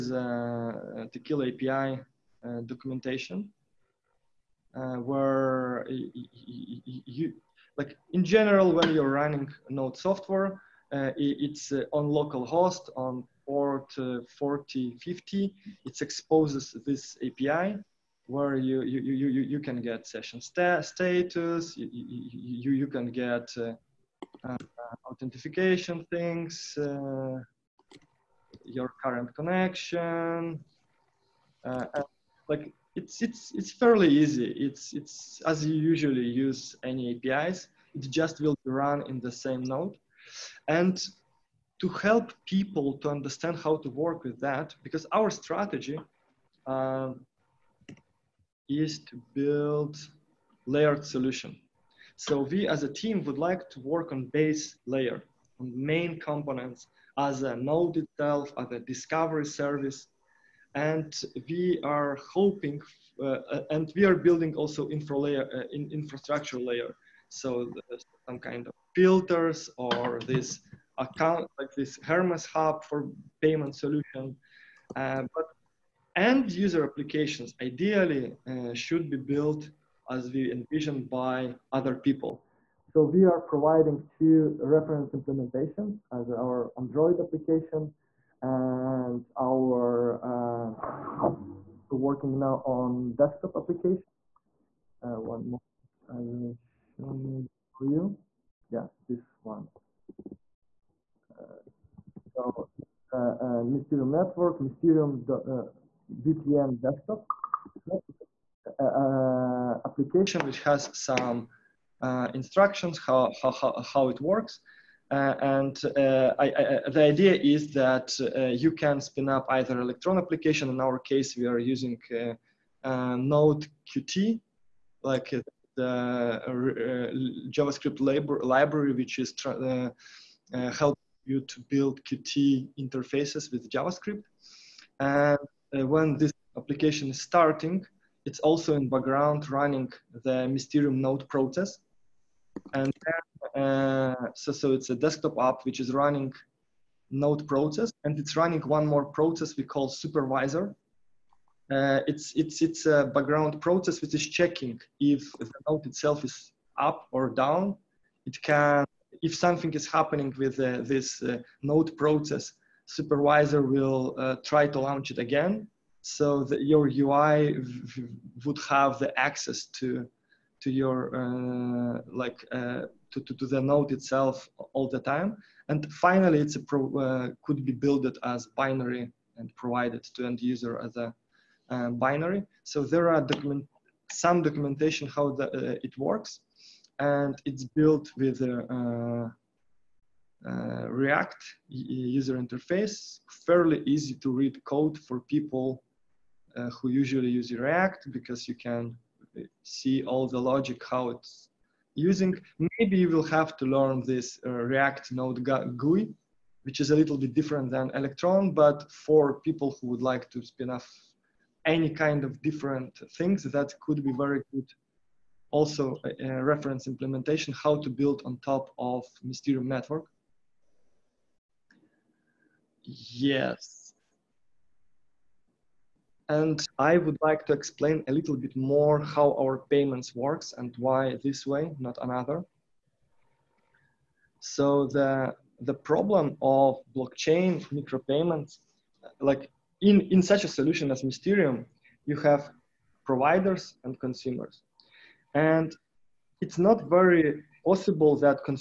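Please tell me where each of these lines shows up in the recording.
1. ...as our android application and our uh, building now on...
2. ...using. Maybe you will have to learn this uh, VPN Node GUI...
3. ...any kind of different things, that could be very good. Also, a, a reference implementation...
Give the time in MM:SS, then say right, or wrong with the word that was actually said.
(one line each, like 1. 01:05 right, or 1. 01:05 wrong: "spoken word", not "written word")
1. 01:26 wrong: "working", not "building"
2. 03:21 wrong: "React", not "VPN"
3. 03:31 right.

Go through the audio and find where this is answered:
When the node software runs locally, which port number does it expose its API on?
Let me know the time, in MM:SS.
00:14.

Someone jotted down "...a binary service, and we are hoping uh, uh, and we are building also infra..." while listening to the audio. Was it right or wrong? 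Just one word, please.
wrong.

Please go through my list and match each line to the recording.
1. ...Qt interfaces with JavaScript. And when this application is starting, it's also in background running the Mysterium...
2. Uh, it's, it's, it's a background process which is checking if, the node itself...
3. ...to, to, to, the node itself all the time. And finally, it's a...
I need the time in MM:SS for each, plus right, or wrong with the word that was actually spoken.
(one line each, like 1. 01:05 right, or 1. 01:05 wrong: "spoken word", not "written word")
1. 02:12 right
2. 02:31 right
3. 02:53 right.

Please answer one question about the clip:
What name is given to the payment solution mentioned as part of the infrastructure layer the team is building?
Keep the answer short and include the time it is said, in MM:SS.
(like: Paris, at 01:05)
Hermes hub, at 01:12.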